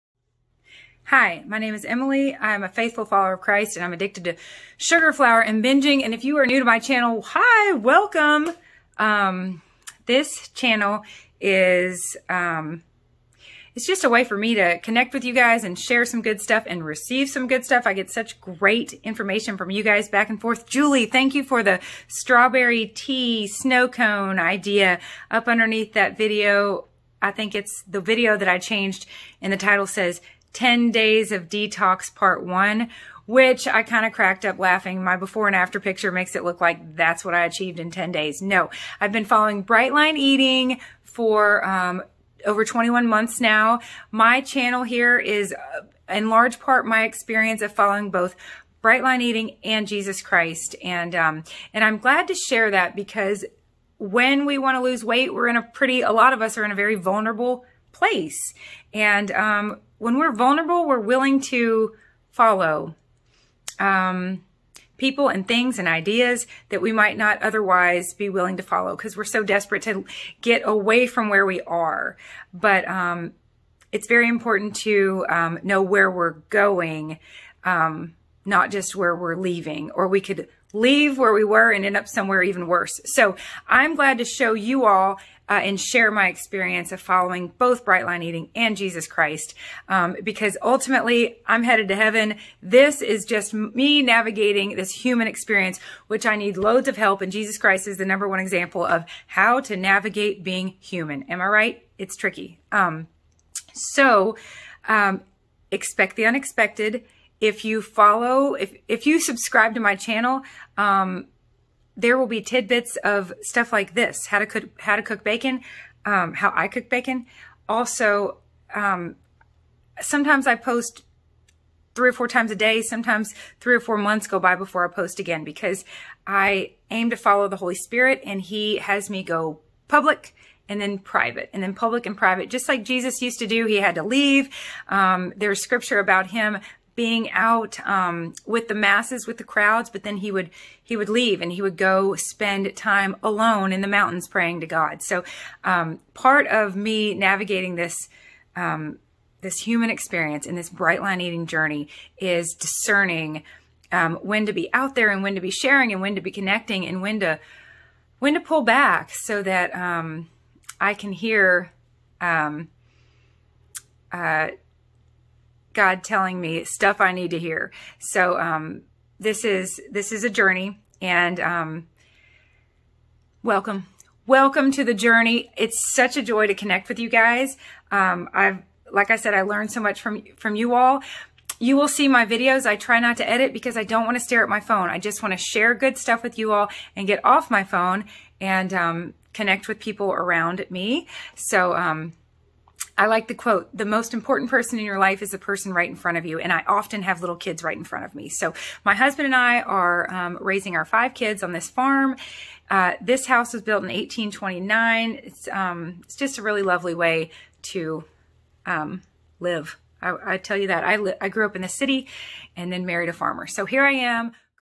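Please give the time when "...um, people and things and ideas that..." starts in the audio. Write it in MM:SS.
01:03.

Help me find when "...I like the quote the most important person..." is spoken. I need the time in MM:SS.
03:13.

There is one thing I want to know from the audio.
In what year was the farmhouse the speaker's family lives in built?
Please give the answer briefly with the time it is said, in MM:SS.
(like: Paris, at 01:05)
1829, at 03:23.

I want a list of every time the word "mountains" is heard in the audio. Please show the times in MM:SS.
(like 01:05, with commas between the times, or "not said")
02:23.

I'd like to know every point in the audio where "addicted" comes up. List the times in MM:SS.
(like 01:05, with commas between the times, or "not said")
00:03.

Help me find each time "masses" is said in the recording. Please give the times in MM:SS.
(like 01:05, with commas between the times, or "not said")
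02:18.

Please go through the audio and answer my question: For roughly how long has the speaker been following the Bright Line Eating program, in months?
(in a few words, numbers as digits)
over 21 months.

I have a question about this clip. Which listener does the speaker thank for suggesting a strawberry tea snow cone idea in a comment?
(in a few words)
Julie.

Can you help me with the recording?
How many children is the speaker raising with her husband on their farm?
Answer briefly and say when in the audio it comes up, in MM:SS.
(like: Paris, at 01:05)
5, at 03:20.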